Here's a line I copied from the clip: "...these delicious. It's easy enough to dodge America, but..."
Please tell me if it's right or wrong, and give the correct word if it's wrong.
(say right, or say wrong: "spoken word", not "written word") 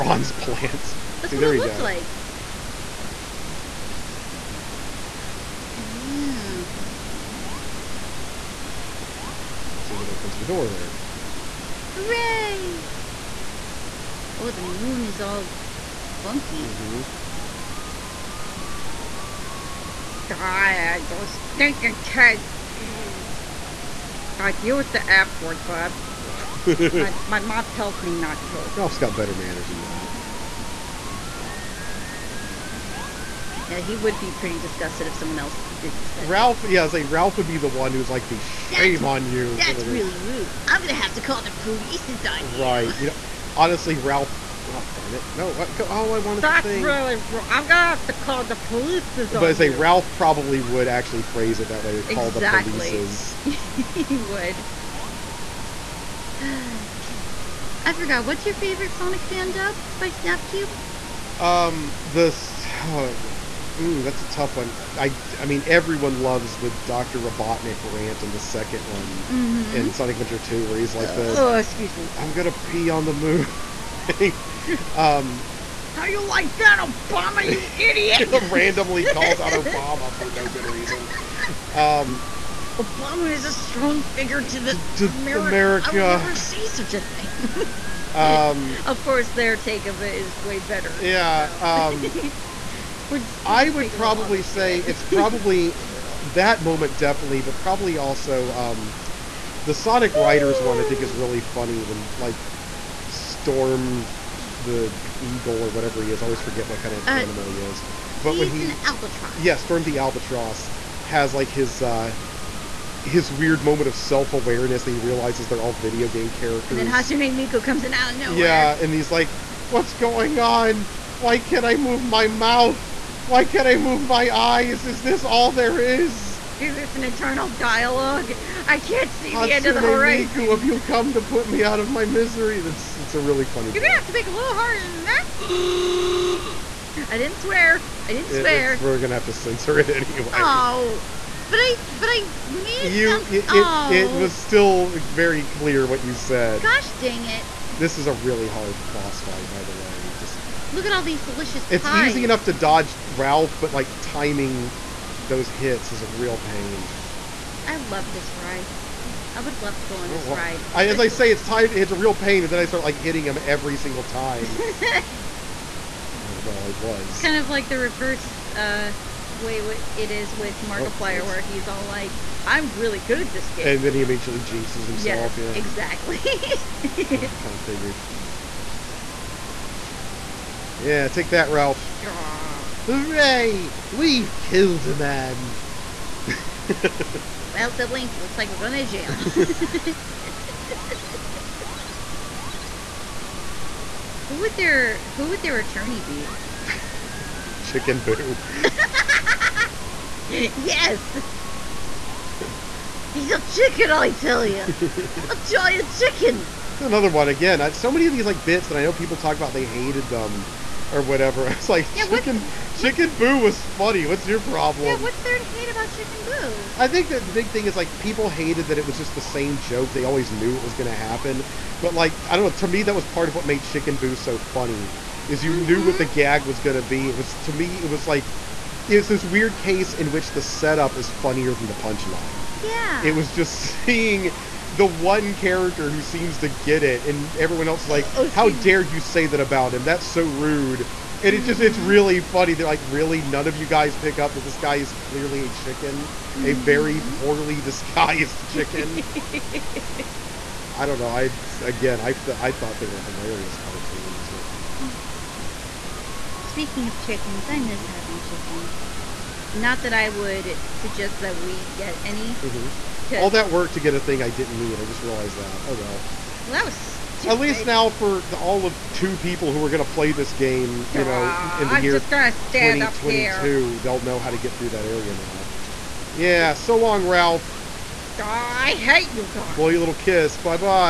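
wrong: "Ralph", not "America".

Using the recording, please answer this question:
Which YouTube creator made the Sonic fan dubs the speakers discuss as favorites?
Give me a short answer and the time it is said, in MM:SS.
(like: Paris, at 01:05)
Snapcube, at 01:00.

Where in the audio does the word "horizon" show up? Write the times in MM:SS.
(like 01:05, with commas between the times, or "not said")
02:09.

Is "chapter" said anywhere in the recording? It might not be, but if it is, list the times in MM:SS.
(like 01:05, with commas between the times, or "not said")
not said.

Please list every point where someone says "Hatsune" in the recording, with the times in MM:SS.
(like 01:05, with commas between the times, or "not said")
01:56, 02:09.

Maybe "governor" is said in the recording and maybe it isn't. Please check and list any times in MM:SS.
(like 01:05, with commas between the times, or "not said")
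not said.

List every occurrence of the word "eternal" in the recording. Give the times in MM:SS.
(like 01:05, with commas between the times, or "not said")
02:07.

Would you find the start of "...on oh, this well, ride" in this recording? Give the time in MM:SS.
02:39.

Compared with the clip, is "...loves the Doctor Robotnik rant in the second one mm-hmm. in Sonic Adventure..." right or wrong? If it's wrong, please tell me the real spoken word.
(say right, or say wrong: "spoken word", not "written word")
right.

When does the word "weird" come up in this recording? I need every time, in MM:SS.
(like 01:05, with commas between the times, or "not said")
01:53, 03:49.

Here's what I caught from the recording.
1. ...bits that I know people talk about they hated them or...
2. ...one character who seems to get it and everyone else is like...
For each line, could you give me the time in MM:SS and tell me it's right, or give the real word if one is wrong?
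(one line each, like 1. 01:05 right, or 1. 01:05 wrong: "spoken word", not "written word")
1. 03:28 right
2. 03:54 right.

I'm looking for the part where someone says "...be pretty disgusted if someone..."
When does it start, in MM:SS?
00:34.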